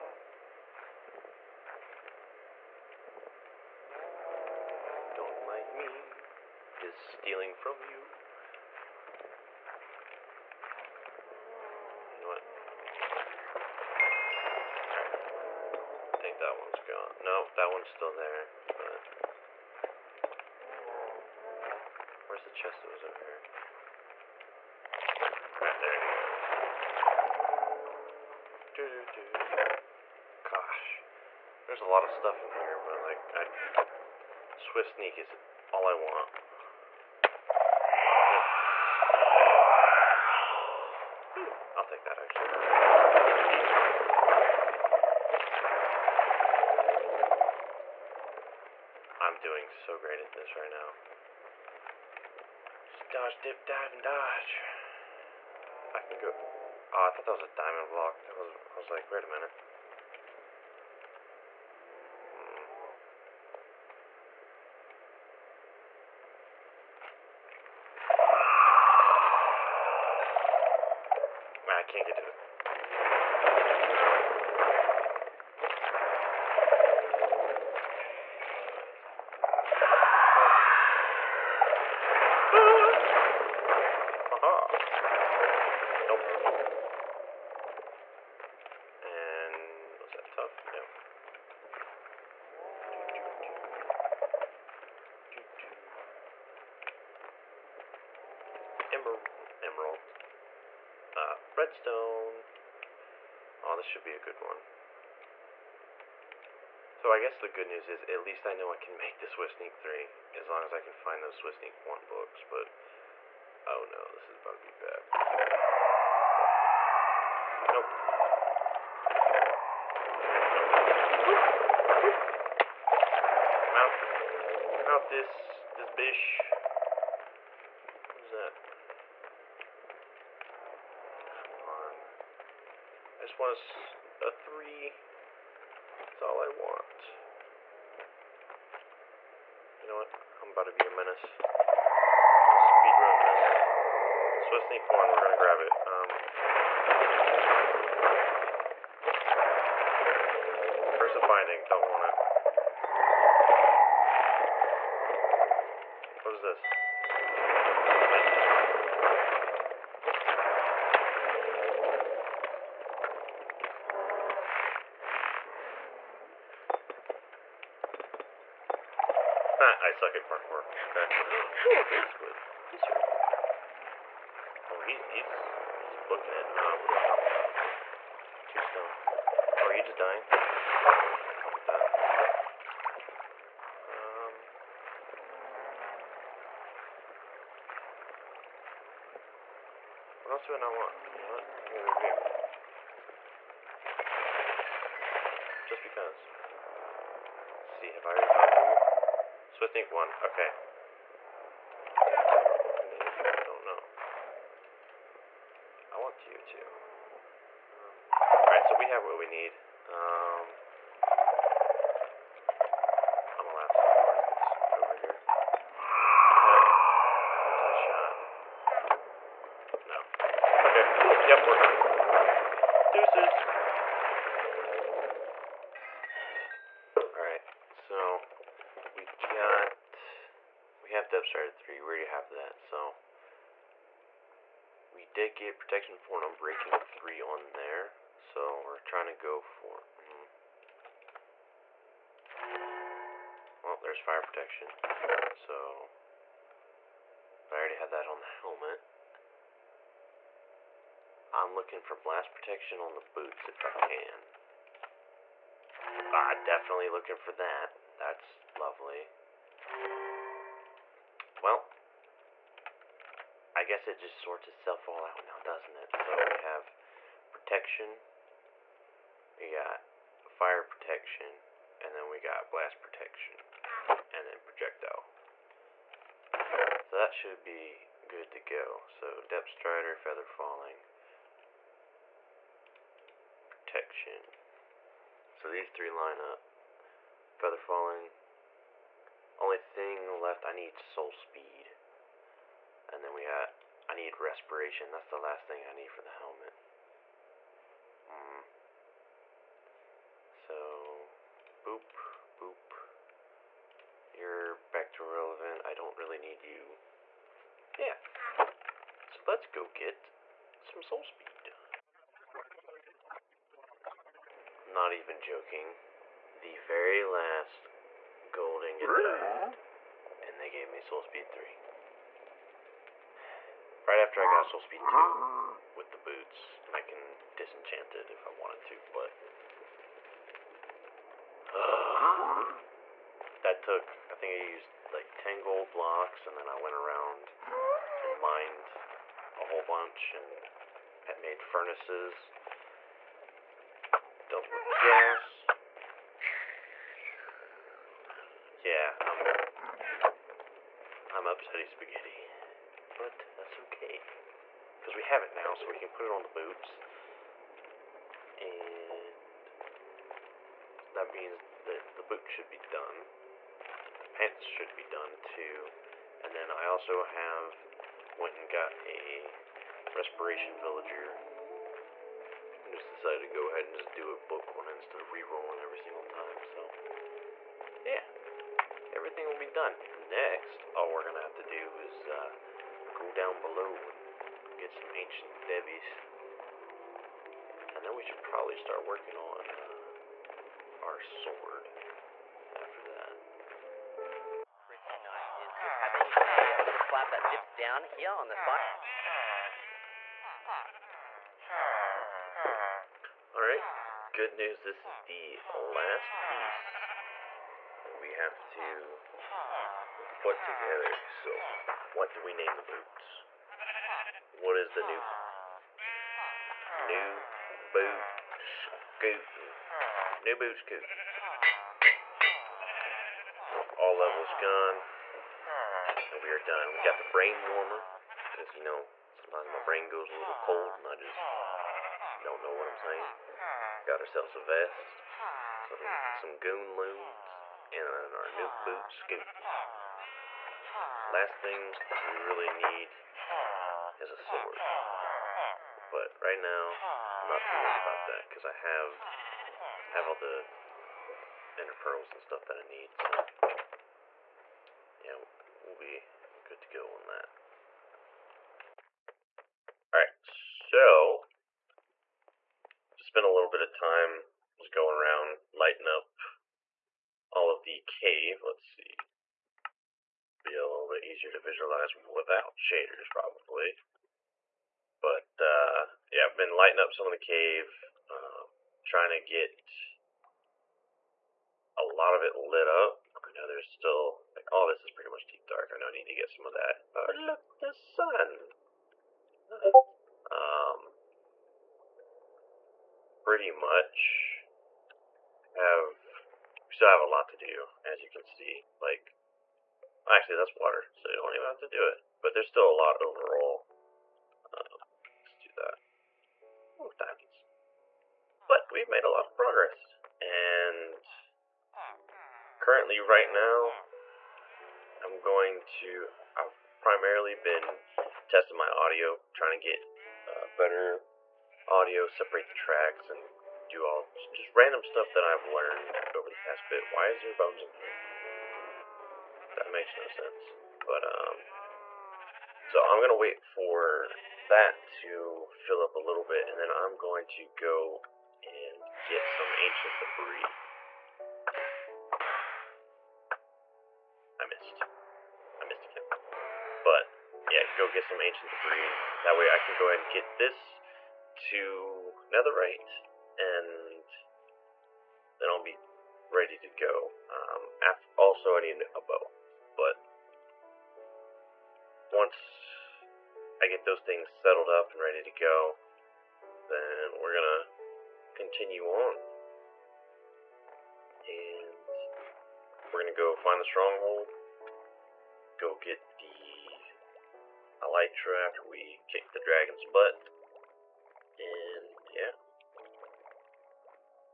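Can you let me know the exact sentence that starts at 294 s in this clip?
That's the last thing I need for the helmet.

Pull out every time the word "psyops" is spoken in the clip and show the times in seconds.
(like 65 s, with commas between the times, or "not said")
not said.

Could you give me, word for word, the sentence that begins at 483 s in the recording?
I know there's still like all oh, this is pretty much deep dark.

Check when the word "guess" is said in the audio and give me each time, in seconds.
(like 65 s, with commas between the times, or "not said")
107 s, 263 s.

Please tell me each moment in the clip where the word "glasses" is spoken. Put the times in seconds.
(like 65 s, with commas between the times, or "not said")
not said.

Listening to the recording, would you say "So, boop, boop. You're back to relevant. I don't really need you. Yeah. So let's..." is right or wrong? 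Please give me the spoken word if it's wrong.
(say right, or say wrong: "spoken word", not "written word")
right.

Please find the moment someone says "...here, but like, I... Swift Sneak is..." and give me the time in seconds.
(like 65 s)
32 s.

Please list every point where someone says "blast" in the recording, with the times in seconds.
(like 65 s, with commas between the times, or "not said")
251 s, 272 s.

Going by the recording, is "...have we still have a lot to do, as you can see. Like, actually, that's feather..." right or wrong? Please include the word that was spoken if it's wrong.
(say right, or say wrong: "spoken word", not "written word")
wrong: "water", not "feather".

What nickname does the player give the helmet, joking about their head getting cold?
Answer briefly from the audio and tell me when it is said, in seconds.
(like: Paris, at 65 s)
Brain warmer, at 427 s.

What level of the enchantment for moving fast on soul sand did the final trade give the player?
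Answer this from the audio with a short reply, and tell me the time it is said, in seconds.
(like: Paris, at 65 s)
3, at 320 s.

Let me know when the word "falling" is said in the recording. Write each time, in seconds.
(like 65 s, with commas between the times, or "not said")
280 s, 287 s.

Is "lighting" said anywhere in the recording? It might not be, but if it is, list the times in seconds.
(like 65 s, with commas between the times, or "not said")
465 s, 476 s.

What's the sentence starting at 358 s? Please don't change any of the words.
And that means that the boots should be done.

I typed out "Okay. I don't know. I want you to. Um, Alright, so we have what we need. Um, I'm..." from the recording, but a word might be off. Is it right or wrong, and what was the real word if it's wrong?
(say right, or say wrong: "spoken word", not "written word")
right.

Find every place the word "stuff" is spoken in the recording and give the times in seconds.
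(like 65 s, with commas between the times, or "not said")
32 s, 452 s, 524 s.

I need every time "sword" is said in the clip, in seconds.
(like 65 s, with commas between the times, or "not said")
391 s, 444 s.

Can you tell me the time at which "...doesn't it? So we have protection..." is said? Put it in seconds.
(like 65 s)
265 s.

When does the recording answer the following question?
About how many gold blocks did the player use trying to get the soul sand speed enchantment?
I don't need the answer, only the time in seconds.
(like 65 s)
335 s.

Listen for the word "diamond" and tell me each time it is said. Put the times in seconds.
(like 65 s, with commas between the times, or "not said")
57 s, 506 s.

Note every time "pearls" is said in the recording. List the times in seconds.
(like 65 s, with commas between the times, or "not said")
451 s.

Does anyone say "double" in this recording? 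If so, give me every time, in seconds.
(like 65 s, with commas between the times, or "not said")
not said.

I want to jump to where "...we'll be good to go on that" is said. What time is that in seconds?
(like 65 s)
455 s.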